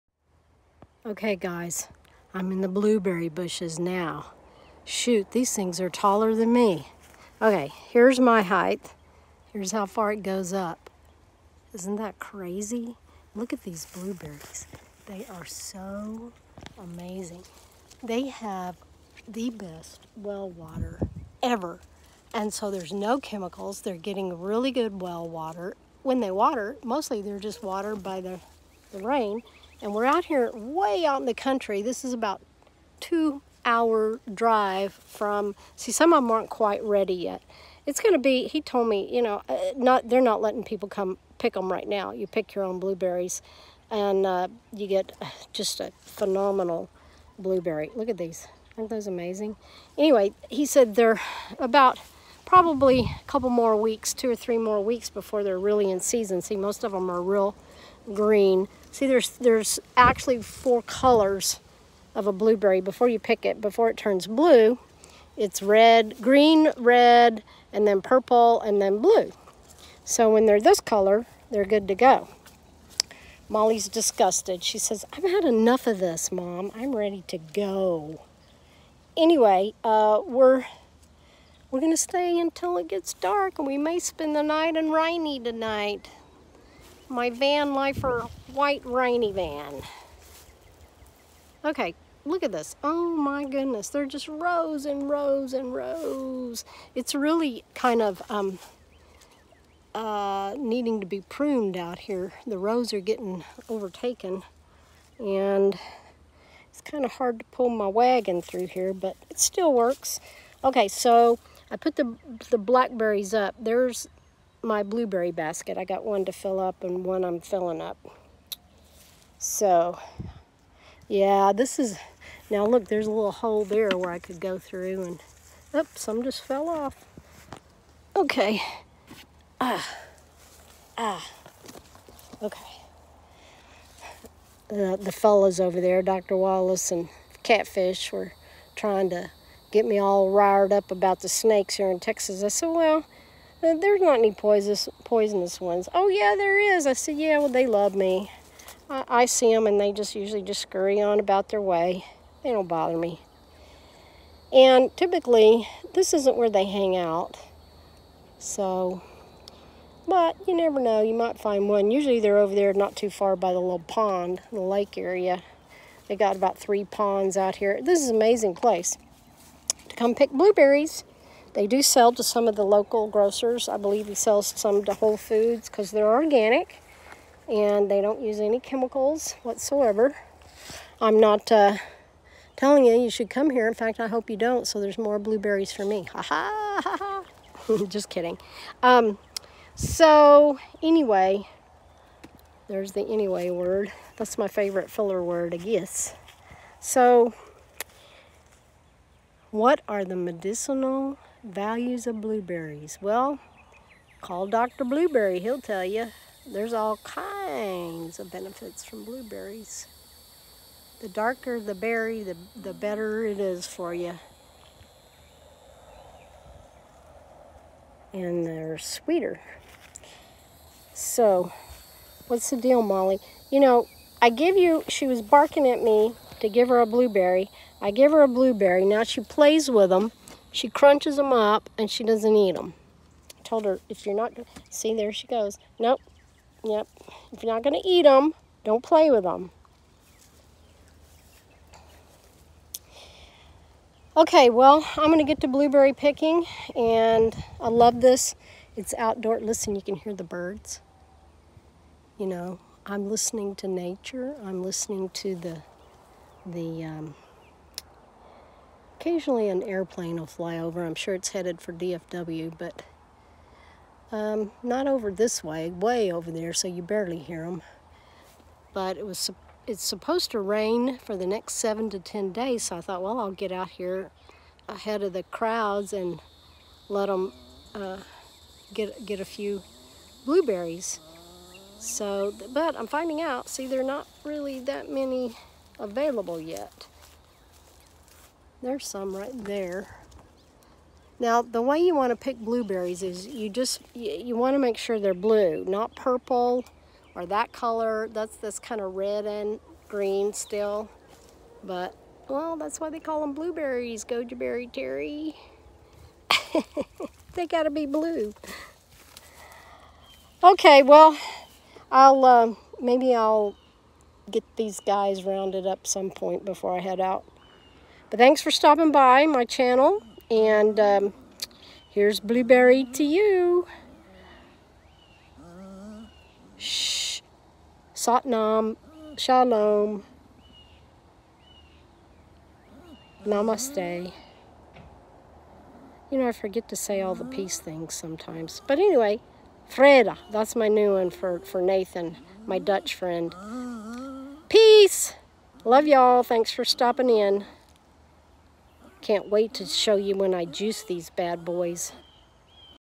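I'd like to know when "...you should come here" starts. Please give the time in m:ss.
3:02.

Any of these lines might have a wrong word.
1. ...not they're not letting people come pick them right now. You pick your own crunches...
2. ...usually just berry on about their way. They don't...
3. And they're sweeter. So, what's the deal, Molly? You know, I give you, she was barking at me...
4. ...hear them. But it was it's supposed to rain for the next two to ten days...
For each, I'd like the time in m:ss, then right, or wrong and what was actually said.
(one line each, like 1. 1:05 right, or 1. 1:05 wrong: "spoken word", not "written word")
1. 0:39 wrong: "blueberries", not "crunches"
2. 2:30 wrong: "scurry", not "berry"
3. 3:38 right
4. 4:27 wrong: "seven", not "two".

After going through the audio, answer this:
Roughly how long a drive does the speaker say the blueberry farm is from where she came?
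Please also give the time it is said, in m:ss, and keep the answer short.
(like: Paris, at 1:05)
2 hours, at 0:32.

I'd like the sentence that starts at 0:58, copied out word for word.
See, there's, there's actually four colors of a blueberry before you pick it.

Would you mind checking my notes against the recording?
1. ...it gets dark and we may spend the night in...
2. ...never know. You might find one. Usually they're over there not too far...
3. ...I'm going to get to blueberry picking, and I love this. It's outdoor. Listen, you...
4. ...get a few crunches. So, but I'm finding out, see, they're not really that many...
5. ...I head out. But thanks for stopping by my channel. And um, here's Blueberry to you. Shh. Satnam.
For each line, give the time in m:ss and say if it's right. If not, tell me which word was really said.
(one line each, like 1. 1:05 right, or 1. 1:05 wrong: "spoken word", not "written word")
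1. 1:22 right
2. 2:40 right
3. 4:04 right
4. 4:39 wrong: "blueberries", not "crunches"
5. 5:16 right.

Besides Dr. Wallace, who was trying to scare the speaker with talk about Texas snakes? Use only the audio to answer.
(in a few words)
Catfish.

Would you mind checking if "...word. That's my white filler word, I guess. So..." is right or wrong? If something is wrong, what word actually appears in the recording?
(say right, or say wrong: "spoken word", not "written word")
wrong: "favorite", not "white".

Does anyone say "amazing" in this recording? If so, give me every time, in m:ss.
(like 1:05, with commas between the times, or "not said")
0:16, 0:49, 2:48.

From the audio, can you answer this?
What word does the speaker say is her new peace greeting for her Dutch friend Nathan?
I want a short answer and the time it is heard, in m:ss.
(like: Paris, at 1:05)
Vrede, at 5:39.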